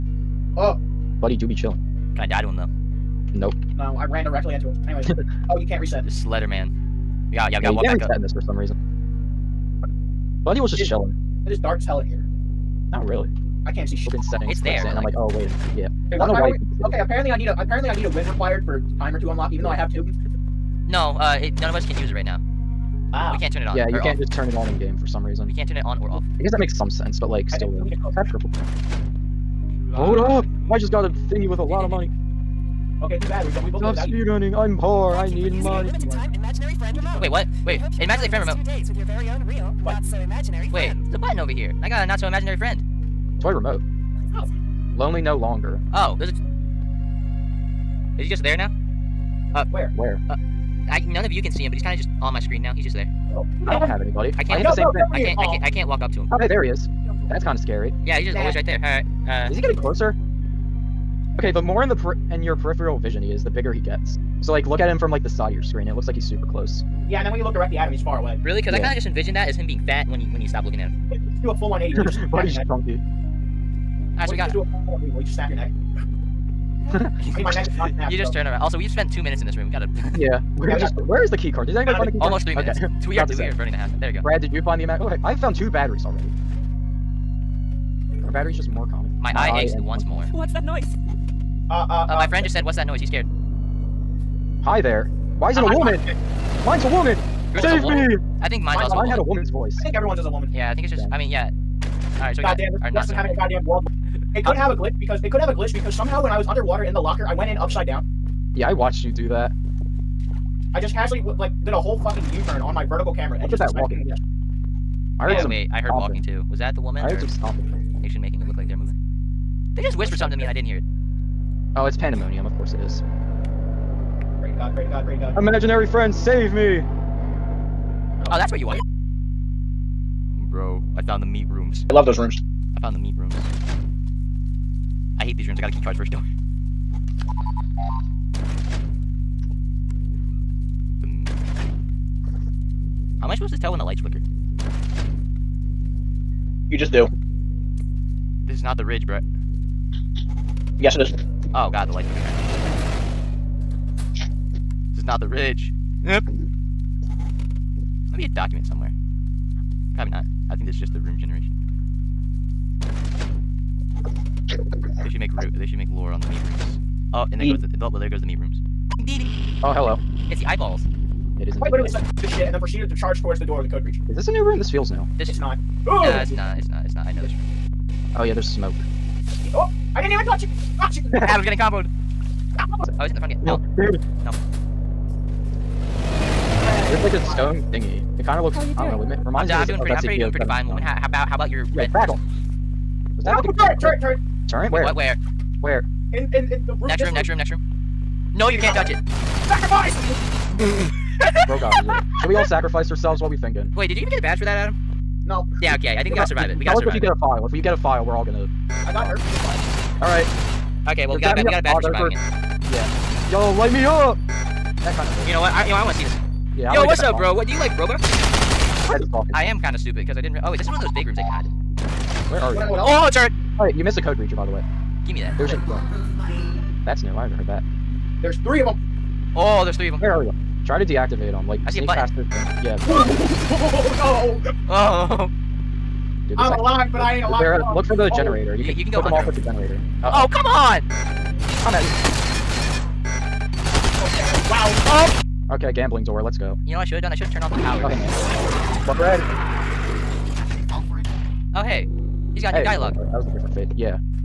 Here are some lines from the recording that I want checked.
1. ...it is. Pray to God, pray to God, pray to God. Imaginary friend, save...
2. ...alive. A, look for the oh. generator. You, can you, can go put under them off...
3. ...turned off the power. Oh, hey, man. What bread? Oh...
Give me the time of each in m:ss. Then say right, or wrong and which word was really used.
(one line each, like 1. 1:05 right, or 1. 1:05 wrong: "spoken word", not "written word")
1. 2:02 right
2. 3:57 right
3. 4:07 right.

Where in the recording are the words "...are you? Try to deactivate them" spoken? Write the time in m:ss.
3:50.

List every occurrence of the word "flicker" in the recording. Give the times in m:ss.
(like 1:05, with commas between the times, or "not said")
2:24, 2:32.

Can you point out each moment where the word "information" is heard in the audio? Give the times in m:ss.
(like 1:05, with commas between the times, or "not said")
not said.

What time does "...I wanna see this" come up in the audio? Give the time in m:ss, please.
3:35.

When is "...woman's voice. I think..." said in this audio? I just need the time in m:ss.
1:39.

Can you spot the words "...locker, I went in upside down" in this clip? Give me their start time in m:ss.
1:46.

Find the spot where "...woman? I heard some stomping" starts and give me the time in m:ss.
1:56.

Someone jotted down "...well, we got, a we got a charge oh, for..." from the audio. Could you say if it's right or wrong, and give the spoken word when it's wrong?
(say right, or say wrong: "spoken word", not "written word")
wrong: "badge", not "charge".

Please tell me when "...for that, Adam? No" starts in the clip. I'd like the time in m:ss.
3:24.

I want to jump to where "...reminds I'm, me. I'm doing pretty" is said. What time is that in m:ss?
3:09.